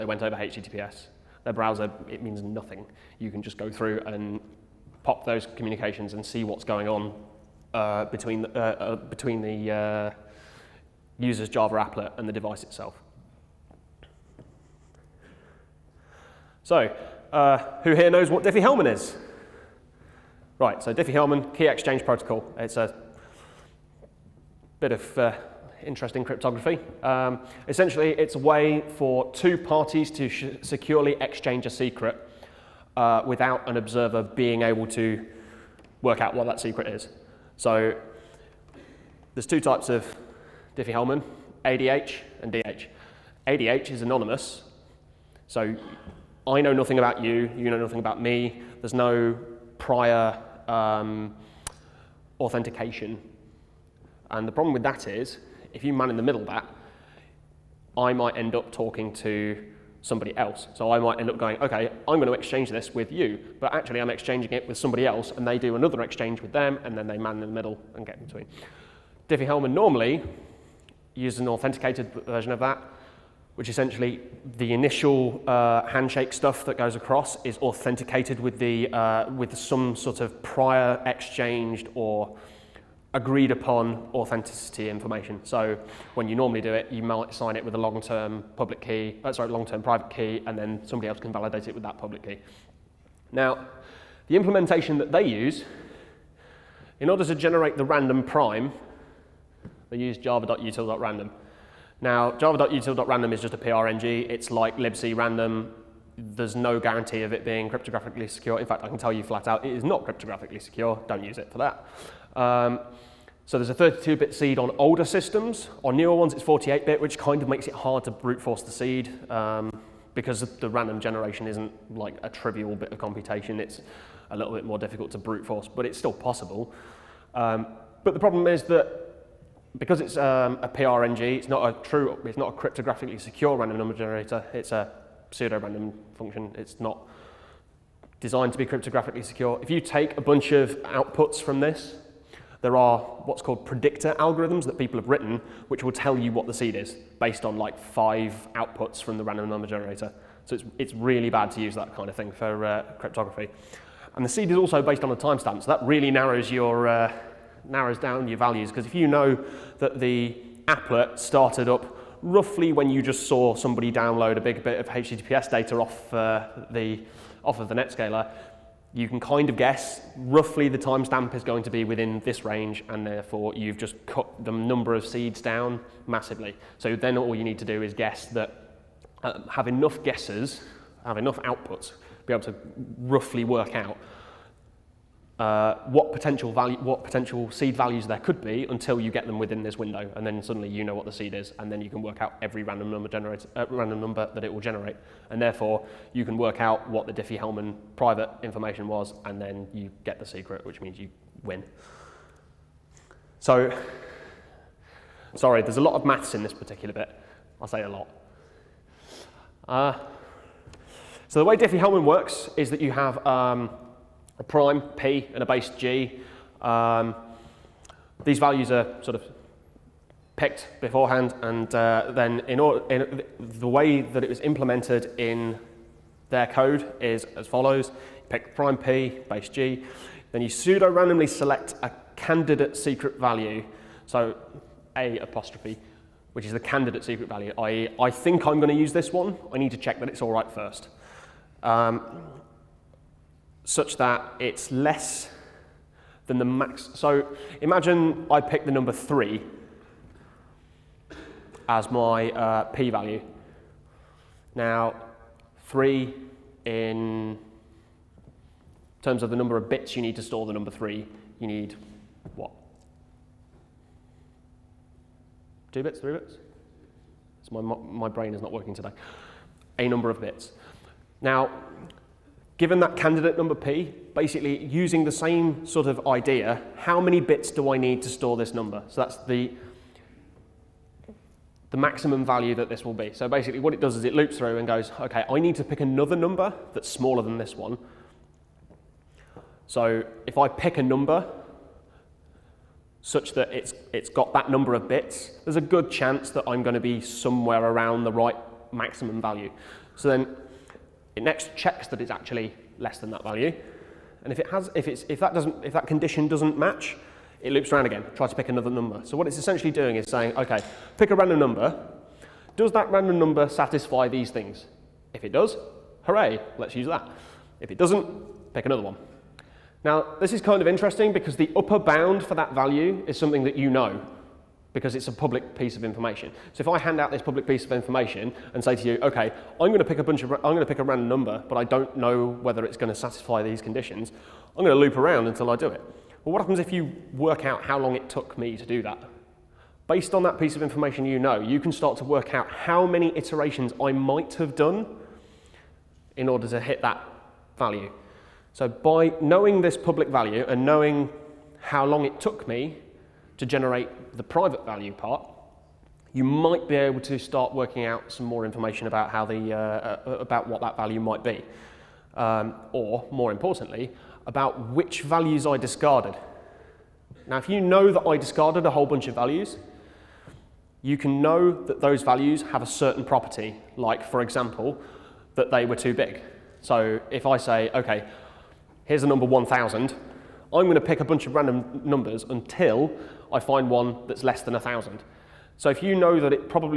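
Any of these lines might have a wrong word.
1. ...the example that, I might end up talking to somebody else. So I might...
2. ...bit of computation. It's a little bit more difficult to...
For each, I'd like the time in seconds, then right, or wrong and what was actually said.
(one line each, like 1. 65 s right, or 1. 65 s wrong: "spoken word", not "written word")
1. 56 s wrong: "middle", not "example"
2. 122 s right.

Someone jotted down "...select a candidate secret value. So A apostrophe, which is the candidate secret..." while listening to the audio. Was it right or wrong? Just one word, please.
right.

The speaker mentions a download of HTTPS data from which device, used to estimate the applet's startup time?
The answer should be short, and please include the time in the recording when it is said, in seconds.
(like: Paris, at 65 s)
Netscaler, at 167 s.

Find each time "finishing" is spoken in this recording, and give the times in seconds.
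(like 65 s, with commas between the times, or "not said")
not said.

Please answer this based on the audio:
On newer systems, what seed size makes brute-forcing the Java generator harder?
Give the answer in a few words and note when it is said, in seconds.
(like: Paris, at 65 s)
48-bit, at 116 s.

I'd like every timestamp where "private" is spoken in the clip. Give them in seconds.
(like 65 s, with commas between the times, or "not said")
89 s, 197 s, 354 s.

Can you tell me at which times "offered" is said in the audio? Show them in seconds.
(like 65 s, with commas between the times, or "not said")
not said.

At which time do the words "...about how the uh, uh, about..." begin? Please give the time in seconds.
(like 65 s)
358 s.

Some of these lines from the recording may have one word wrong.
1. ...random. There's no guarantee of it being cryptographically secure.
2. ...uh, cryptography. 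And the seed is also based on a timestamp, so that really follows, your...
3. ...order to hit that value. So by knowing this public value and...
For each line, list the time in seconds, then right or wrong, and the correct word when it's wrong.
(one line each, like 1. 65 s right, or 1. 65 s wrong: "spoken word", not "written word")
1. 105 s right
2. 152 s wrong: "narrows", not "follows"
3. 346 s right.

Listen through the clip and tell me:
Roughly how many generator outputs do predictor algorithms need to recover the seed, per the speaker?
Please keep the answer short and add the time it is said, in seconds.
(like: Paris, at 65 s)
5, at 147 s.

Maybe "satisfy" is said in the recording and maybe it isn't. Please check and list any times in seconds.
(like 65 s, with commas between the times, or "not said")
313 s, 332 s.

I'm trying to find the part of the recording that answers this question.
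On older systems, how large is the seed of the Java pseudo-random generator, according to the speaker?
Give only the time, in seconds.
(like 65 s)
113 s.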